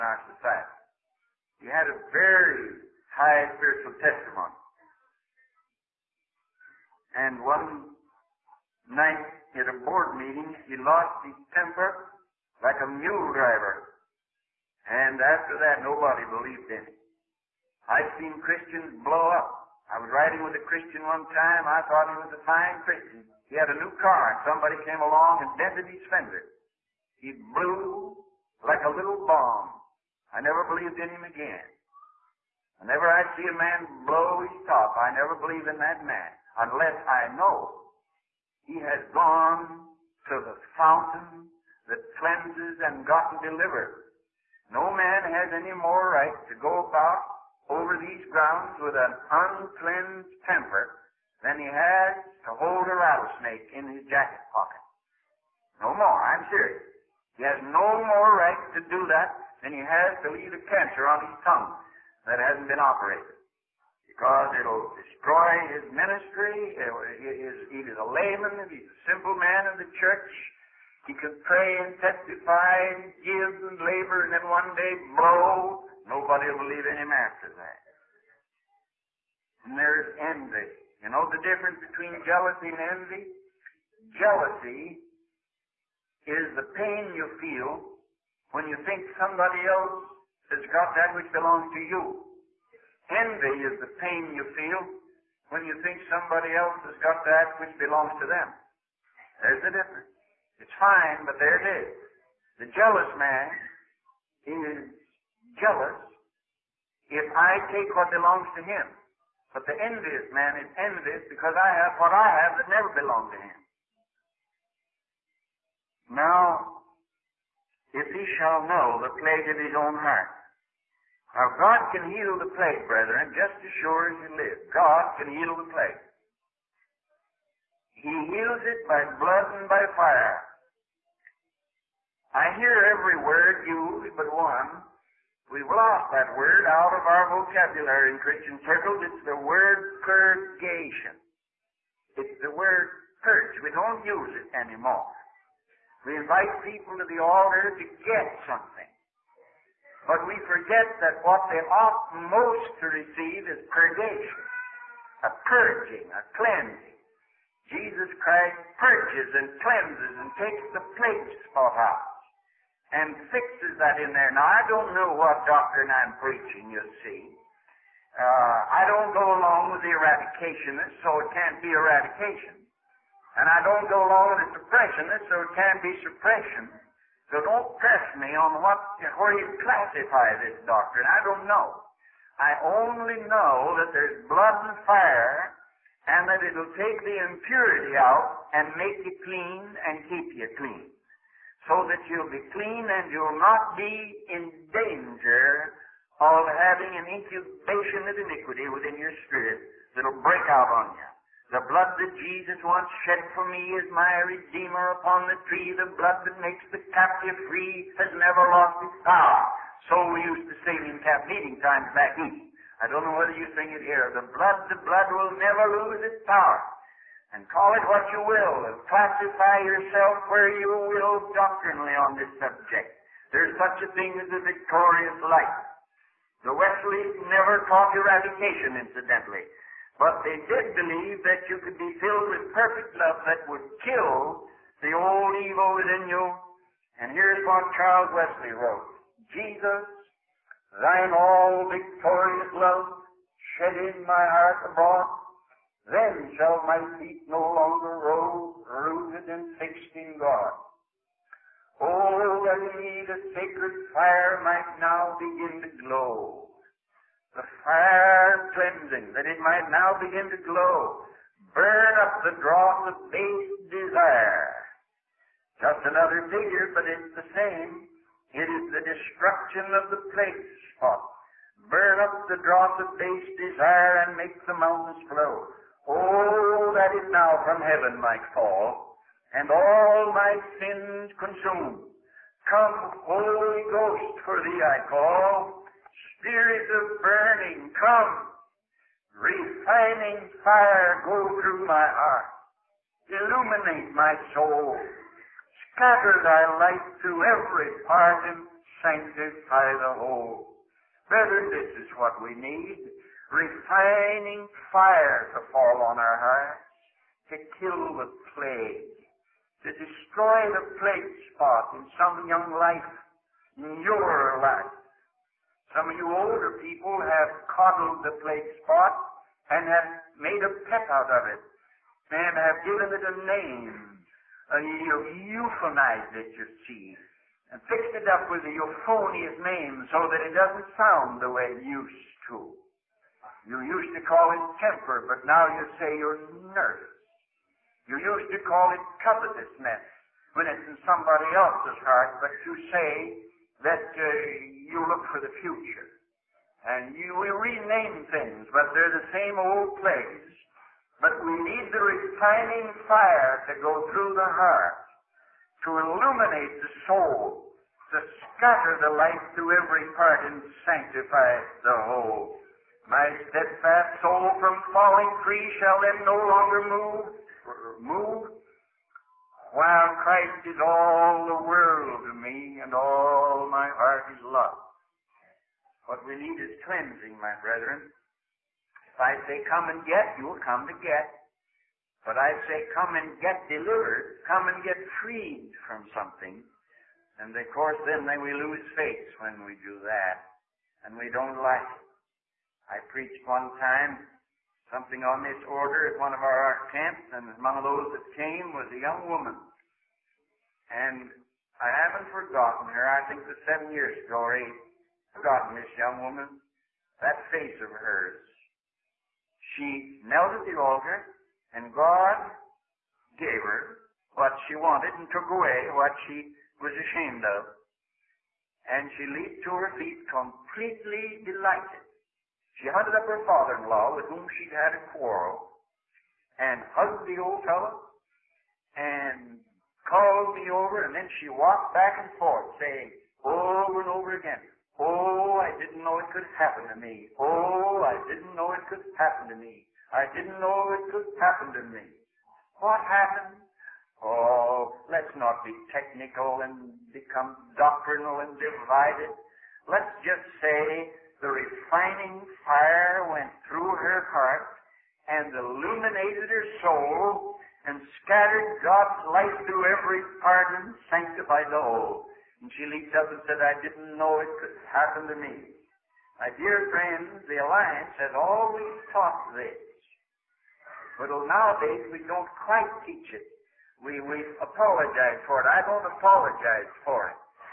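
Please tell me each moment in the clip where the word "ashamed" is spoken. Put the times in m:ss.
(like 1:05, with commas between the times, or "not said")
6:56.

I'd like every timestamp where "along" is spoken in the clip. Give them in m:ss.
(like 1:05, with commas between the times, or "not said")
0:25, 2:49, 2:54.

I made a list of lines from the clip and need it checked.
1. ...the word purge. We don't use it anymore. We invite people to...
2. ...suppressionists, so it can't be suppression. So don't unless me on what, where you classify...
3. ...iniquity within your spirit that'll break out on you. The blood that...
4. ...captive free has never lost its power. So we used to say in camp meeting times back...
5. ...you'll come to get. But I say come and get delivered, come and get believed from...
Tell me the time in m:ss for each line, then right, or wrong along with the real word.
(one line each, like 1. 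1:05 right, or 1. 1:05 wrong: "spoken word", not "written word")
1. 2:22 right
2. 2:54 wrong: "press", not "unless"
3. 3:18 right
4. 3:26 right
5. 6:20 wrong: "freed", not "believed".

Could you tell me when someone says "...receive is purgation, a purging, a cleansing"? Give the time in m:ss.
2:32.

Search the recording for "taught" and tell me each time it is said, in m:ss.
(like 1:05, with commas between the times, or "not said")
3:47, 7:48.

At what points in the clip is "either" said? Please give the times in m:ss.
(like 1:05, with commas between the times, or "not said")
1:07.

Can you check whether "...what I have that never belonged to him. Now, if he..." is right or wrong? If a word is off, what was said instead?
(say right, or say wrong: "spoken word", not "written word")
right.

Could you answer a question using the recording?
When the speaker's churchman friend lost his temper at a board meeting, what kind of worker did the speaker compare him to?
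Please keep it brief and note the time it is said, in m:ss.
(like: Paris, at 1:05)
mule driver, at 0:12.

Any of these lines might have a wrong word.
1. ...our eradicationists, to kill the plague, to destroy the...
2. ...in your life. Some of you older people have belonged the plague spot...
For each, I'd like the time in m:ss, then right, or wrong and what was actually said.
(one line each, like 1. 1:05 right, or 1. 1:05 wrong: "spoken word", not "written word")
1. 5:06 wrong: "hearts", not "eradicationists"
2. 5:13 wrong: "coddled", not "belonged".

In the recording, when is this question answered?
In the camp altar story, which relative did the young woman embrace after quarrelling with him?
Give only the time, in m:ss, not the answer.
7:03.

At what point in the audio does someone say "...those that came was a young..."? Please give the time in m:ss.
6:37.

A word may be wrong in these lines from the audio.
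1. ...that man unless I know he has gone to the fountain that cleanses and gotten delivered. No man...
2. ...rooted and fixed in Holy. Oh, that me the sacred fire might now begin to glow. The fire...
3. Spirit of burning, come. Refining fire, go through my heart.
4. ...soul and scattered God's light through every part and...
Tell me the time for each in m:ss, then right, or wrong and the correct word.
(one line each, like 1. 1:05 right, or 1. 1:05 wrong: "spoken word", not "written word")
1. 0:35 right
2. 4:08 wrong: "God", not "Holy"
3. 4:46 right
4. 7:36 right.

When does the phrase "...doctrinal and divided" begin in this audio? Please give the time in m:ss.
7:27.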